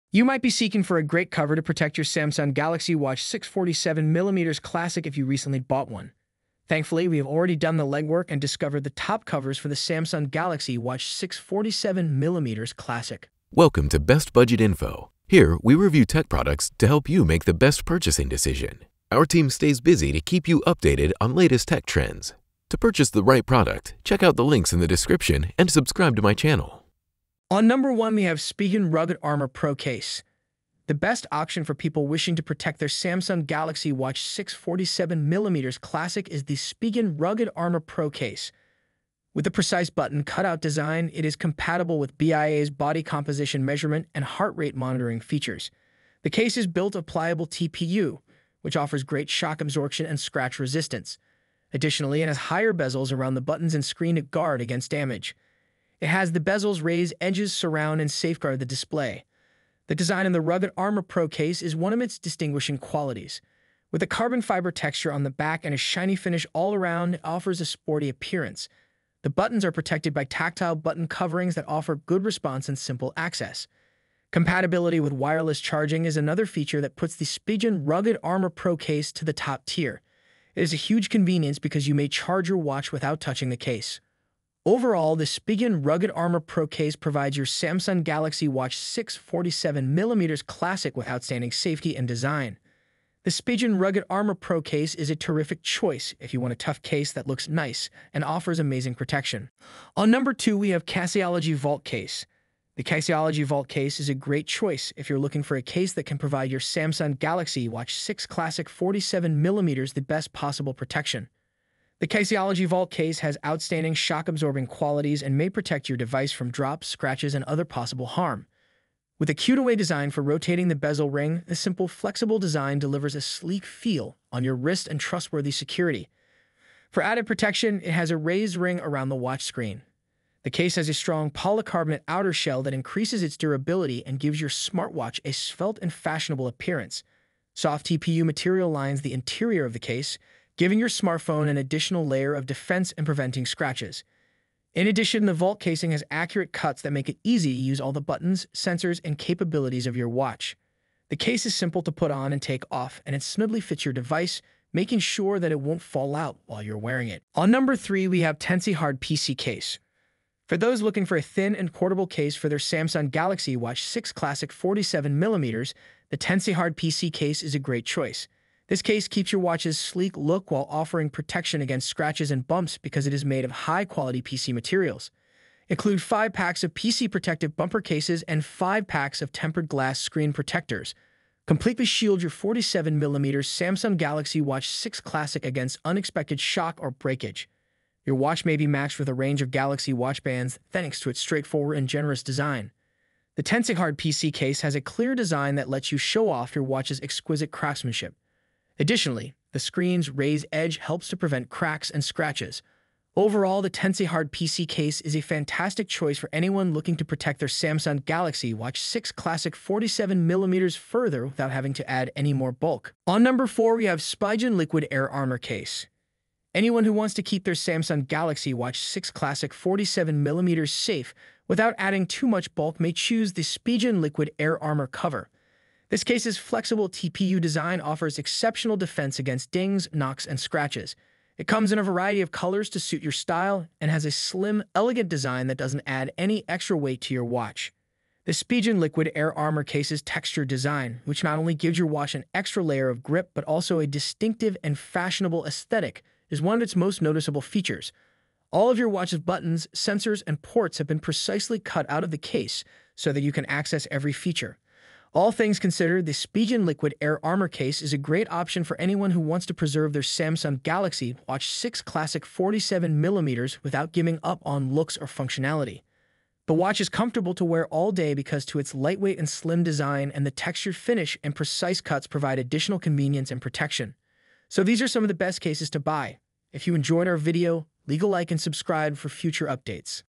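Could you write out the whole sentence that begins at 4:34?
So these are some of the best cases to buy.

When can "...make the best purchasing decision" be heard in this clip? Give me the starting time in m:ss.
0:17.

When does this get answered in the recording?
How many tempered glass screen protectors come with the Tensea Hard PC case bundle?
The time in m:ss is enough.
2:58.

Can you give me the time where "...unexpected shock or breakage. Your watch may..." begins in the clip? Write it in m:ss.
3:05.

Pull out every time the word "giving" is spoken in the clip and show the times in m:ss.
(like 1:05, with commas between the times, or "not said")
2:20, 4:23.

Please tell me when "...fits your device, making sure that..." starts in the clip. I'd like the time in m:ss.
2:33.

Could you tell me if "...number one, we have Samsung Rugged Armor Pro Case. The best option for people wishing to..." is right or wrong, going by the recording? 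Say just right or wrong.
wrong.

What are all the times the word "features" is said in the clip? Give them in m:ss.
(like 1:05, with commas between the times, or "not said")
0:45, 1:16, 4:07, 4:14.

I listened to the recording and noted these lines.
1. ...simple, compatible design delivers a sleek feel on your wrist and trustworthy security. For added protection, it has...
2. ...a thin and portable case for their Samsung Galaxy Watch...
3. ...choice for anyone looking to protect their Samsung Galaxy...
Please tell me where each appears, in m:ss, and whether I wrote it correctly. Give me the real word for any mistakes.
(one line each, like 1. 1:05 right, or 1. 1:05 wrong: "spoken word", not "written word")
1. 2:01 wrong: "flexible", not "compatible"
2. 2:41 right
3. 3:25 right.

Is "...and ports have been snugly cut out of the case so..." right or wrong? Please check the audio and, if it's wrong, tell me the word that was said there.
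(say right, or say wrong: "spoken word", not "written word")
wrong: "precisely", not "snugly".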